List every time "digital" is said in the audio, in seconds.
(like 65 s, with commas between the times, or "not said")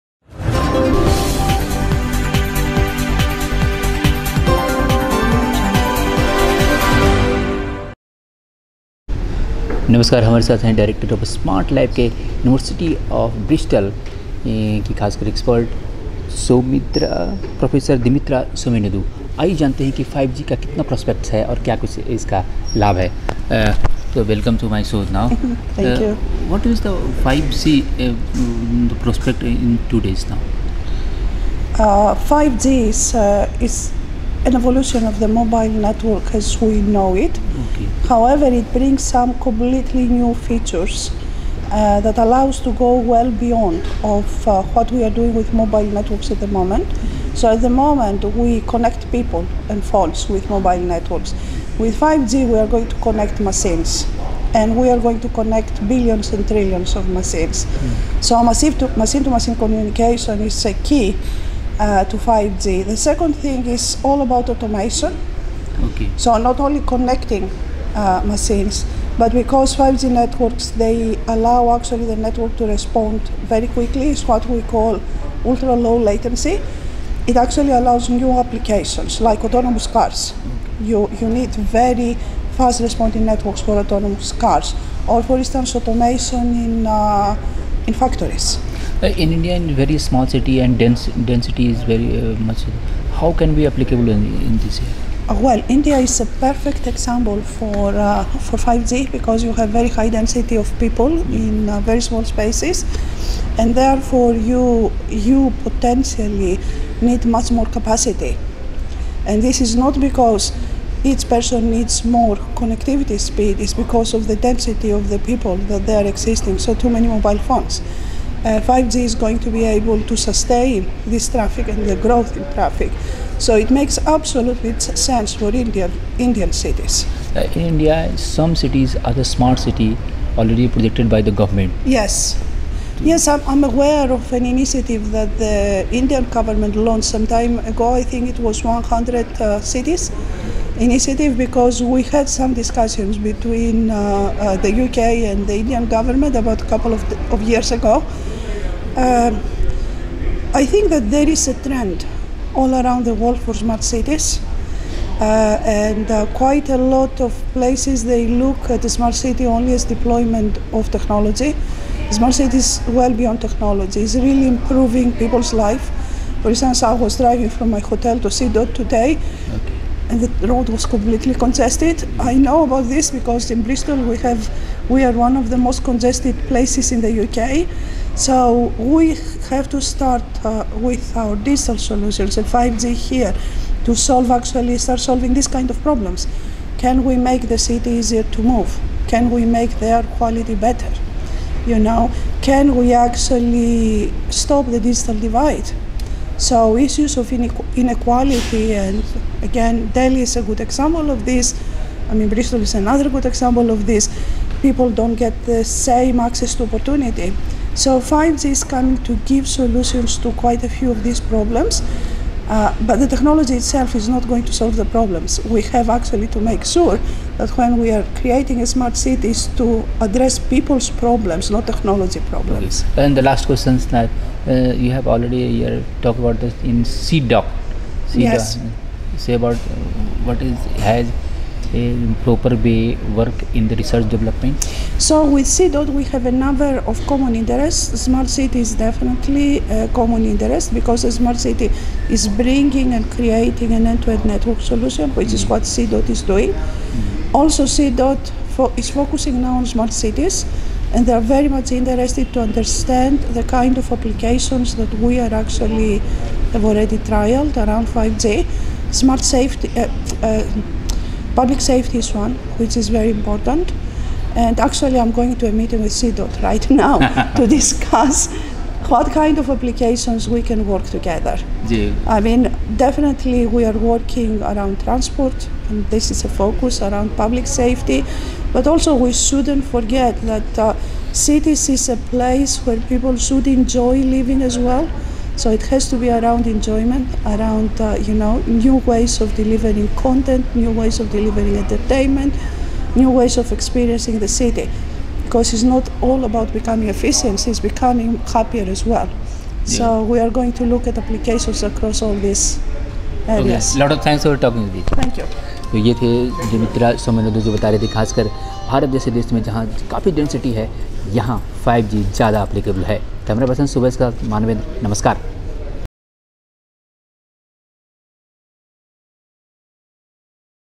181 s, 194 s.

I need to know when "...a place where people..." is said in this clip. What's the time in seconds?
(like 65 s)
281 s.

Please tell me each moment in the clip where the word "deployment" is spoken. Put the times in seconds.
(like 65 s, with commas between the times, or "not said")
159 s.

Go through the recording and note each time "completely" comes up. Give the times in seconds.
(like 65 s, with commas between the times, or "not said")
39 s, 170 s.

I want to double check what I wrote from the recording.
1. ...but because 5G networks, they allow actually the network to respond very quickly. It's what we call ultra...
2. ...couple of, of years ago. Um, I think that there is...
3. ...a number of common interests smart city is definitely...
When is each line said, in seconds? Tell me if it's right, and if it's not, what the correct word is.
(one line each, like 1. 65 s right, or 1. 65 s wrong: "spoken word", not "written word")
1. 69 s right
2. 146 s right
3. 236 s right.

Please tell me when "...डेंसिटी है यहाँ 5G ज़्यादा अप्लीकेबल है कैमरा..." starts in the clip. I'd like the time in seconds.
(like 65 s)
310 s.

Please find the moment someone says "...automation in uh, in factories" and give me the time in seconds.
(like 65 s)
85 s.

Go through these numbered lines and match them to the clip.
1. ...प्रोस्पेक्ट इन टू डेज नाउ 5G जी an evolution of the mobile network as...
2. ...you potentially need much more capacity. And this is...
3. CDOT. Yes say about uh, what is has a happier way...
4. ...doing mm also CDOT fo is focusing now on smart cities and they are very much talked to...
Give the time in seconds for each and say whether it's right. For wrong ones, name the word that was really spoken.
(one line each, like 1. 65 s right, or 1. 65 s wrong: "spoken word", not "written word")
1. 29 s right
2. 105 s right
3. 228 s wrong: "proper", not "happier"
4. 246 s wrong: "interested", not "talked".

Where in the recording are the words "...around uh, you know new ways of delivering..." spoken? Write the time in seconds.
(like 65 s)
287 s.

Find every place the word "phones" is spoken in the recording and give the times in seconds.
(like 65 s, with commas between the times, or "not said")
49 s, 117 s.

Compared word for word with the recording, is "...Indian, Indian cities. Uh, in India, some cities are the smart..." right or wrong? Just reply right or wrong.
right.